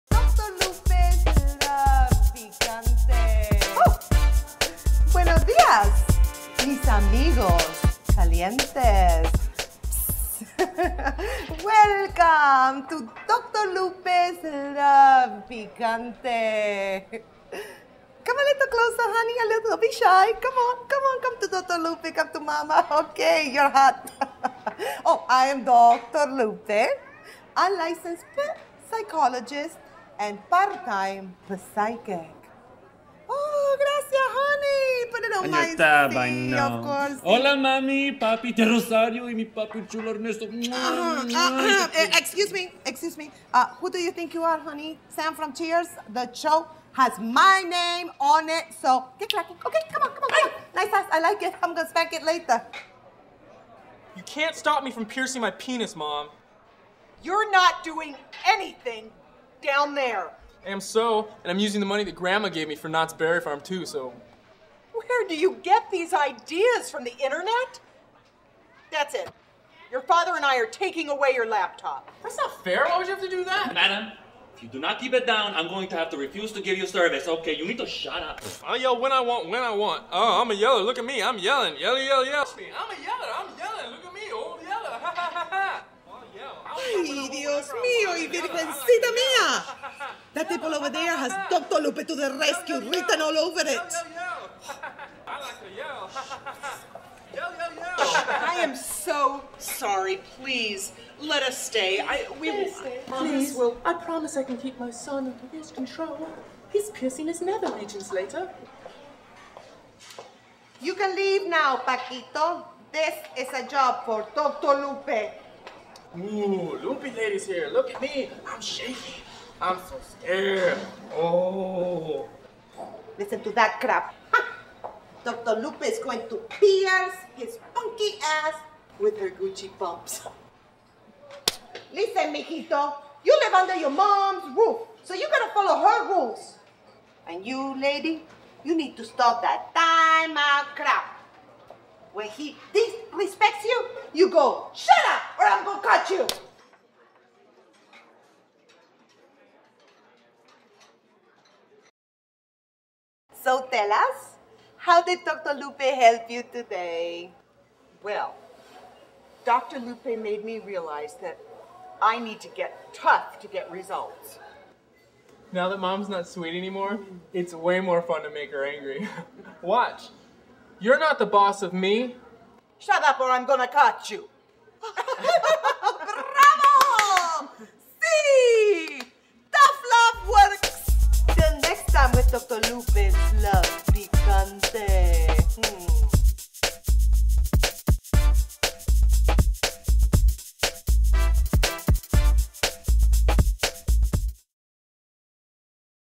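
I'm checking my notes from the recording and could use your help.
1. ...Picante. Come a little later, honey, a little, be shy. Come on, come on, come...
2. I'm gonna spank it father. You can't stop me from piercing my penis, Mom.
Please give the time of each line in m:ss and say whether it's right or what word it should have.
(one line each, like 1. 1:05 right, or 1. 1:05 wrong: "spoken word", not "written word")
1. 0:15 wrong: "closer", not "later"
2. 0:51 wrong: "later", not "father".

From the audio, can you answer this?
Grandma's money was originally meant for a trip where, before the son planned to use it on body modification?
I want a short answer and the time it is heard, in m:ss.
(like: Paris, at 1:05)
Knott's Berry Farm, at 1:02.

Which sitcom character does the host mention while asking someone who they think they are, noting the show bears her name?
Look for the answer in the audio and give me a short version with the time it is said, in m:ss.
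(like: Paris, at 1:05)
Sam from Cheers, at 0:45.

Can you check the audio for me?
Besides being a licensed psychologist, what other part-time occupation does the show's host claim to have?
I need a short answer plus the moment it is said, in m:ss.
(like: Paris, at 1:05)
Psychic, at 0:31.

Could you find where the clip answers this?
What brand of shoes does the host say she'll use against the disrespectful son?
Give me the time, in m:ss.
2:09.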